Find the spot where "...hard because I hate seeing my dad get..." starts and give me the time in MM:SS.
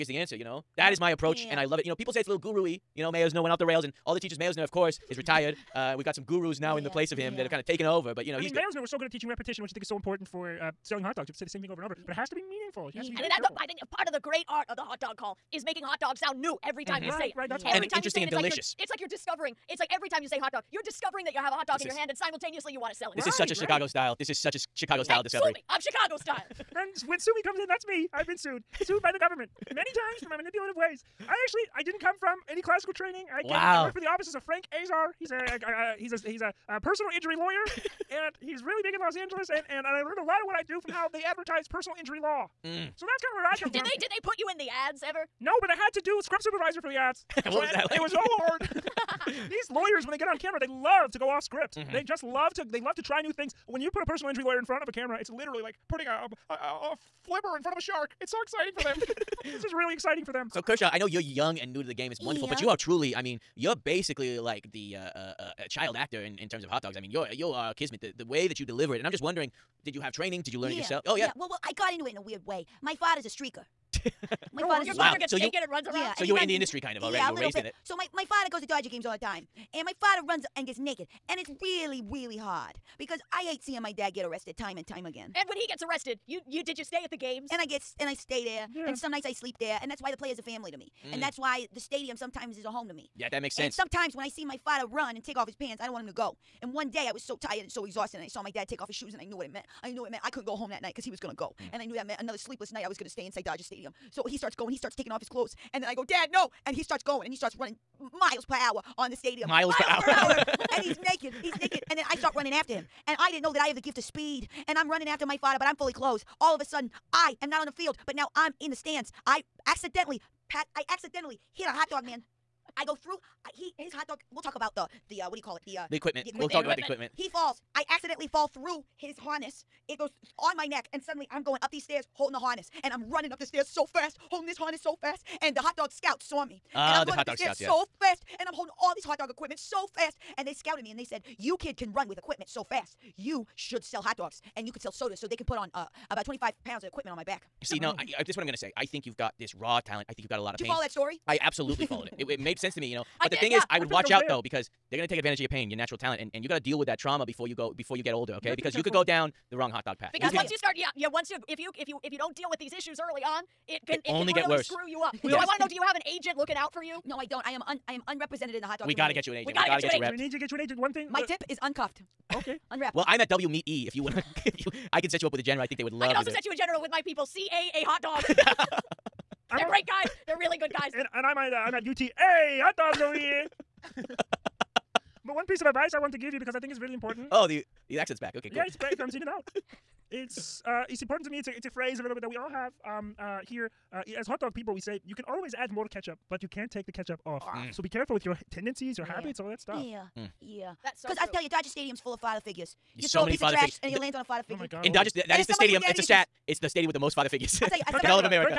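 01:22.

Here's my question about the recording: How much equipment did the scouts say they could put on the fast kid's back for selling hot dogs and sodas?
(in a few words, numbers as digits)
25 pounds.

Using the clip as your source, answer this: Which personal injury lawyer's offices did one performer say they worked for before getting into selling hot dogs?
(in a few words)
Frank Azar.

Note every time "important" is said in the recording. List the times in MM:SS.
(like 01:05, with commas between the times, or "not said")
00:09, 03:06, 03:11.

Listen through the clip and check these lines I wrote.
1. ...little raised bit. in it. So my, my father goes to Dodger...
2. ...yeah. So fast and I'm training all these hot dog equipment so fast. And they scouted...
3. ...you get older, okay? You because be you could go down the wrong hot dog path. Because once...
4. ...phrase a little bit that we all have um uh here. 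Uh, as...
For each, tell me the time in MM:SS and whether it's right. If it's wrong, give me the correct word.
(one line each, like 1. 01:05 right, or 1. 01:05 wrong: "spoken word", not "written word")
1. 01:17 right
2. 02:17 wrong: "holding", not "training"
3. 02:37 right
4. 03:11 right.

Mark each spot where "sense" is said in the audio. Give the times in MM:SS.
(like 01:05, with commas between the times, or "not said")
01:33, 02:32.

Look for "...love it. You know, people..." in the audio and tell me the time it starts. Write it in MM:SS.
00:01.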